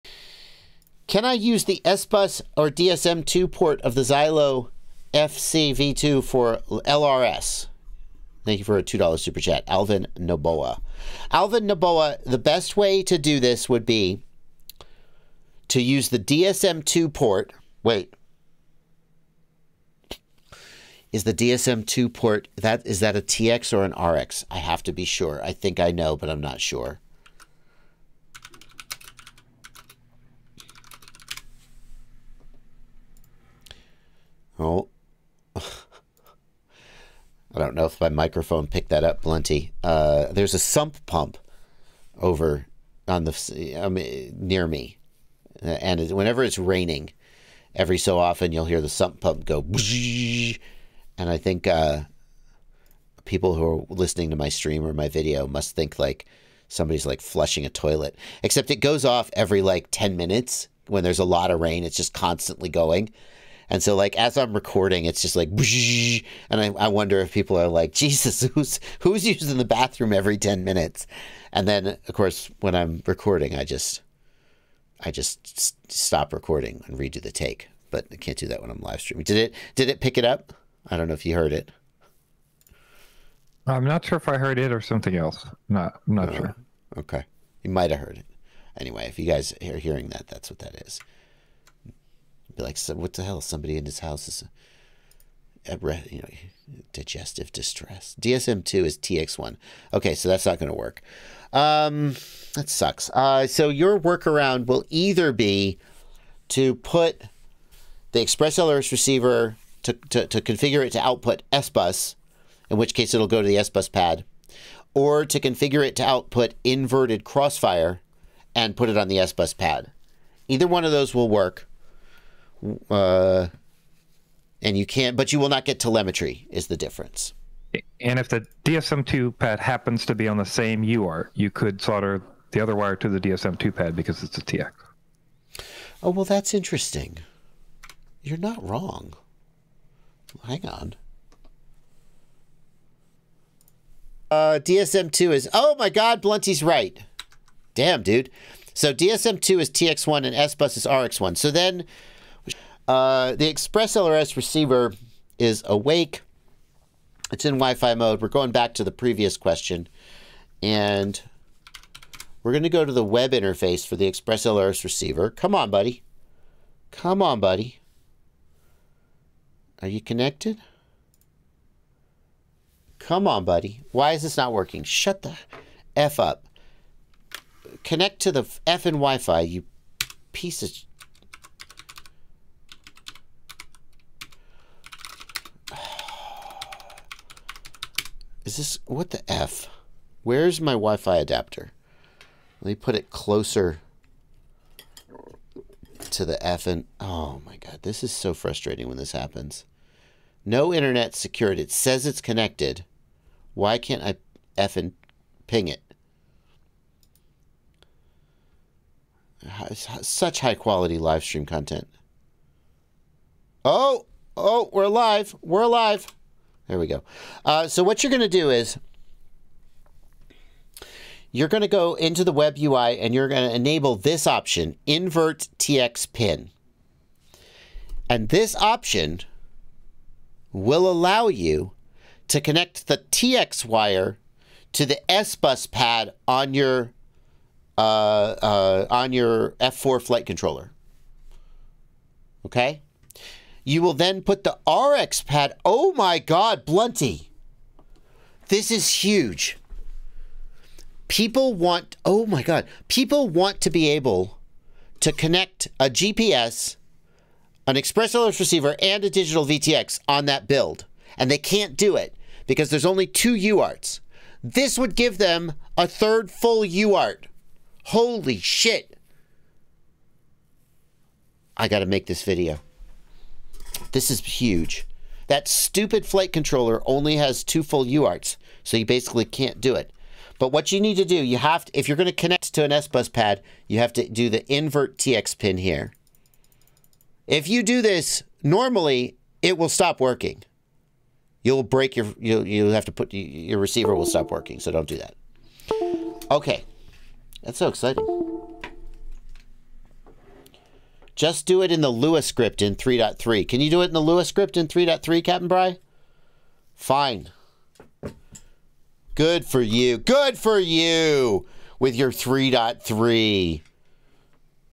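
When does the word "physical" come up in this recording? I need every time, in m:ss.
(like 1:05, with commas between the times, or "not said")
not said.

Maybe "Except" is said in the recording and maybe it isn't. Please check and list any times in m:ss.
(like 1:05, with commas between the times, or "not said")
0:58.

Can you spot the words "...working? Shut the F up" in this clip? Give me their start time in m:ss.
2:54.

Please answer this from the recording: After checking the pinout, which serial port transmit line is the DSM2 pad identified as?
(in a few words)
TX1.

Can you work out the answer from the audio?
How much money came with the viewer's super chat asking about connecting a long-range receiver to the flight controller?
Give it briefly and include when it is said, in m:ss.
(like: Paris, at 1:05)
$2, at 0:08.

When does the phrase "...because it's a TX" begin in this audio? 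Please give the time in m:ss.
2:13.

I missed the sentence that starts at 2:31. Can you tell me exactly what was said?
So then uh, the Express LRS receiver is awake.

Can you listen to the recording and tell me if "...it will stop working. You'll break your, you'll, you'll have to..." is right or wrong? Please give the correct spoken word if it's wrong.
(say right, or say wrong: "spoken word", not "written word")
right.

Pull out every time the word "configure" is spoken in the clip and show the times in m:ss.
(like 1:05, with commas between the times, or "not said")
1:50, 1:55.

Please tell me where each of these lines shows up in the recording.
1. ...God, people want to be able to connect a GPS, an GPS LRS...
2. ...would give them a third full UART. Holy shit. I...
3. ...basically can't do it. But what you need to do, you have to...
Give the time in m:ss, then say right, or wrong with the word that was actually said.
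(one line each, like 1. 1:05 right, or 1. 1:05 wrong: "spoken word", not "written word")
1. 4:12 wrong: "Express", not "GPS"
2. 4:24 right
3. 4:38 right.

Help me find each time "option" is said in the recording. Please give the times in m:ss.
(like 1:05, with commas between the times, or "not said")
3:44, 3:48.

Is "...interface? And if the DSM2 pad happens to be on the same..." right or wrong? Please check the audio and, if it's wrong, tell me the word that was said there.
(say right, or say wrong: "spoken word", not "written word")
wrong: "difference", not "interface".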